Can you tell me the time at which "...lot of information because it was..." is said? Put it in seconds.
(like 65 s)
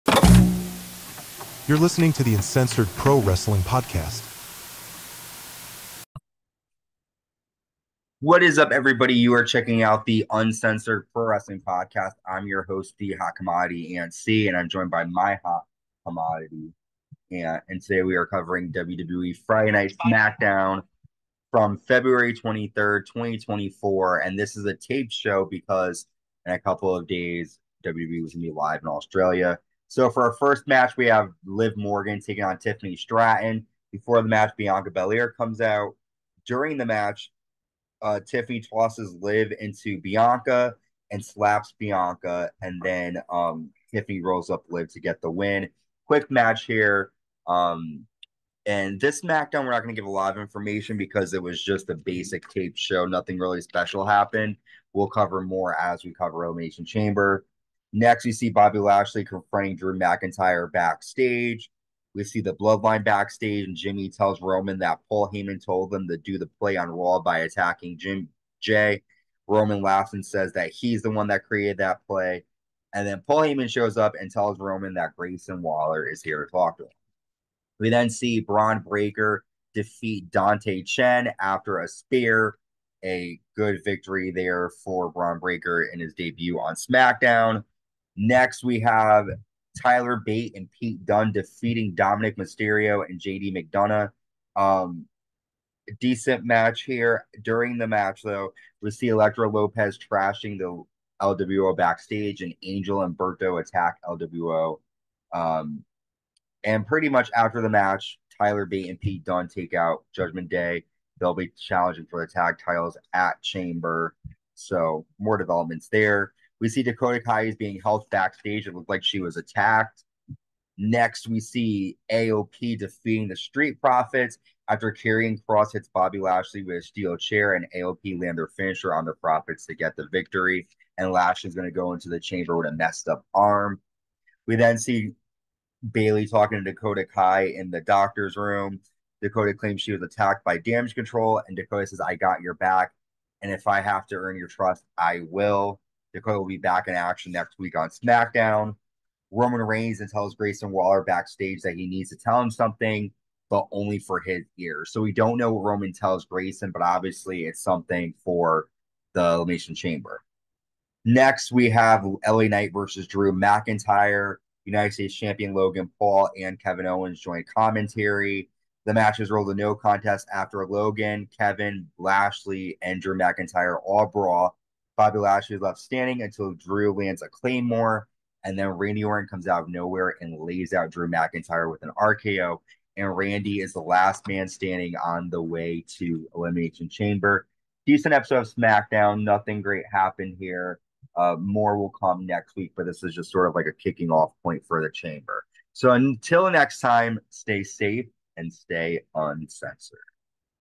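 50 s.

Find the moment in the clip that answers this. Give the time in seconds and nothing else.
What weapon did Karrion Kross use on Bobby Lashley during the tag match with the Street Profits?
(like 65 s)
126 s.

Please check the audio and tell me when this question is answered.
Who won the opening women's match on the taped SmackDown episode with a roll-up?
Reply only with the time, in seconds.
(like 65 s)
43 s.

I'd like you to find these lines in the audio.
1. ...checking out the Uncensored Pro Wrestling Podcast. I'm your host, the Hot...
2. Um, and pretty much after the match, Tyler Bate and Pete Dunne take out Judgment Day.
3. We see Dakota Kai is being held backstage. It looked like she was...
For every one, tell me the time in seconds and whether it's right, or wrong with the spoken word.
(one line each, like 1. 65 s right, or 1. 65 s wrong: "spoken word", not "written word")
1. 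9 s right
2. 105 s right
3. 116 s right.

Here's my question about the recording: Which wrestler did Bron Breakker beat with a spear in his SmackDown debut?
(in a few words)
Dante Chen.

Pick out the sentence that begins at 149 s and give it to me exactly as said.
Roman Reigns and tells Grayson Waller backstage that he needs to tell him something, but only for his ears.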